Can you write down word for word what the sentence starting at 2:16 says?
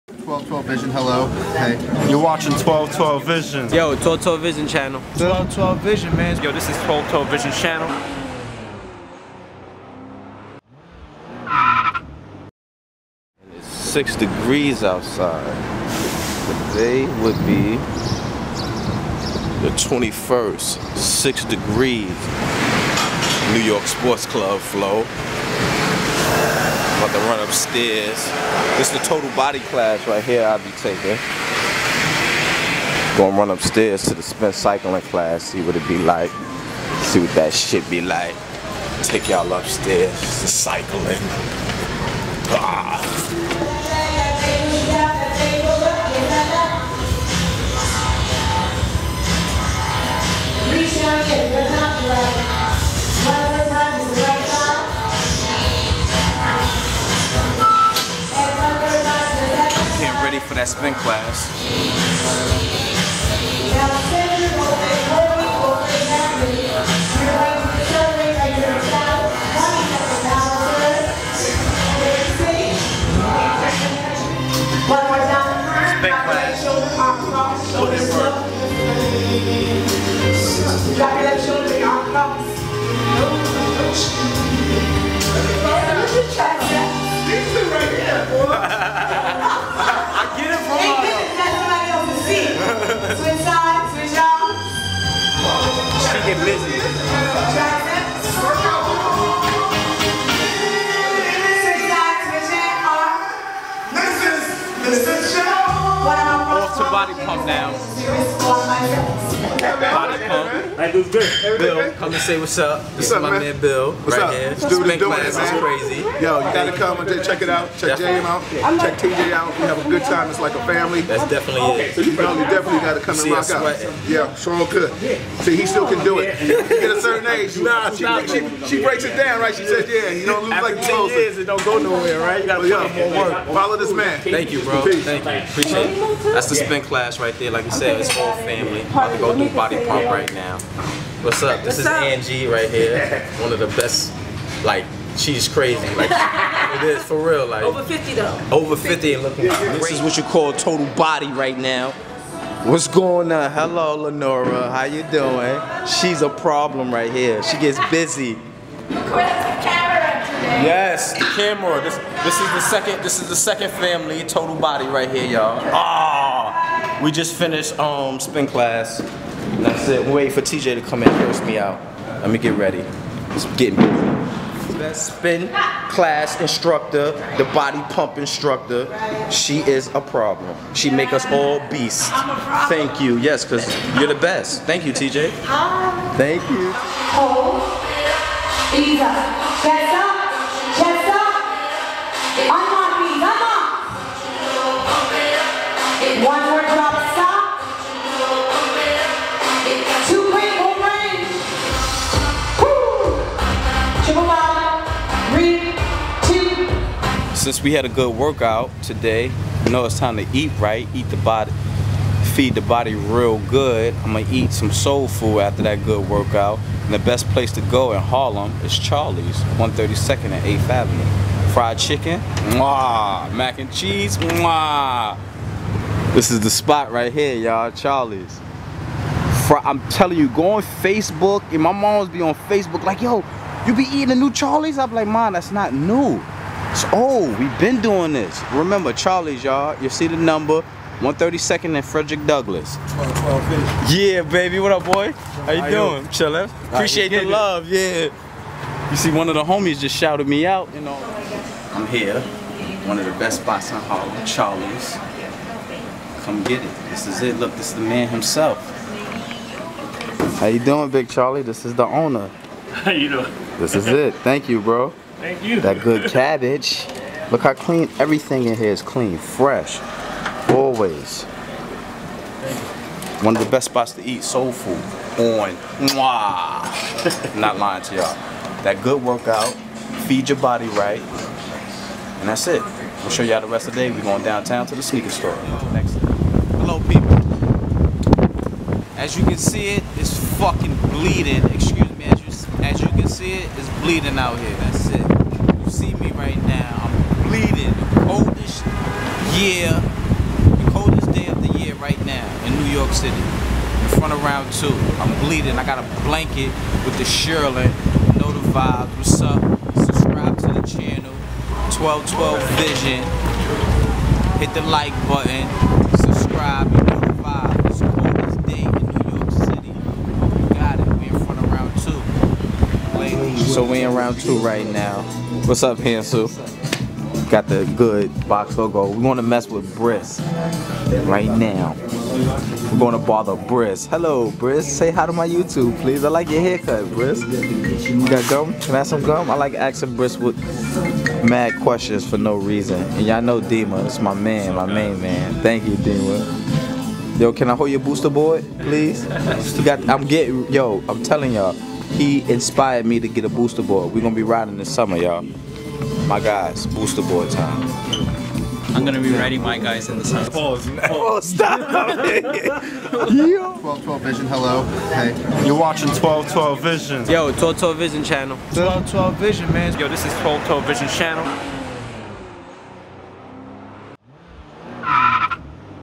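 That's the spin in class right there.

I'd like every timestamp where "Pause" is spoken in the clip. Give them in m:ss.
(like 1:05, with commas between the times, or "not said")
6:00.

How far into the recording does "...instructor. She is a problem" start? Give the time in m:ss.
2:58.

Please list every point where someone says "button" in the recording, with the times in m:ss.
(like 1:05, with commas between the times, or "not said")
5:15.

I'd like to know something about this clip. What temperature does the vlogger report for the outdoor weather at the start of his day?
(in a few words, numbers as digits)
6 degrees.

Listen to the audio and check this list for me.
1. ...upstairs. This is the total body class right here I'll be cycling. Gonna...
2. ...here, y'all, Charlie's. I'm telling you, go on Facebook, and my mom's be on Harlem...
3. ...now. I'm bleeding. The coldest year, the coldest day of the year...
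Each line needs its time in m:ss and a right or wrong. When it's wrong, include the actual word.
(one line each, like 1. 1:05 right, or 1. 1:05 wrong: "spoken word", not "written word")
1. 0:27 wrong: "taking", not "cycling"
2. 3:47 wrong: "Facebook", not "Harlem"
3. 4:56 right.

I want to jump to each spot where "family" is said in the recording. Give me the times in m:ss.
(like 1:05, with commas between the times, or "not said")
2:00, 2:18, 2:43.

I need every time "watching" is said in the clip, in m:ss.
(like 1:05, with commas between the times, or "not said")
0:02, 6:05.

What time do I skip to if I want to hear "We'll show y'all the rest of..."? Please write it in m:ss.
4:43.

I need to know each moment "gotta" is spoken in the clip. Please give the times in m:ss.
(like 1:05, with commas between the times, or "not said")
1:56, 2:02, 2:12.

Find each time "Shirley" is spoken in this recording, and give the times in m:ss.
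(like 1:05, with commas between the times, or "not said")
5:07.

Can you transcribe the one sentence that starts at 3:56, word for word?
So, oh, we've been doing this.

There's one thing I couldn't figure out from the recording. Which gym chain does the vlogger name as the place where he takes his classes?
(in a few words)
New York Sports Club.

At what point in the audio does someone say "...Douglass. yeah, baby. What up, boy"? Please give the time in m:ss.
4:02.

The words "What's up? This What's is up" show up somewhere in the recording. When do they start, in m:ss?
2:21.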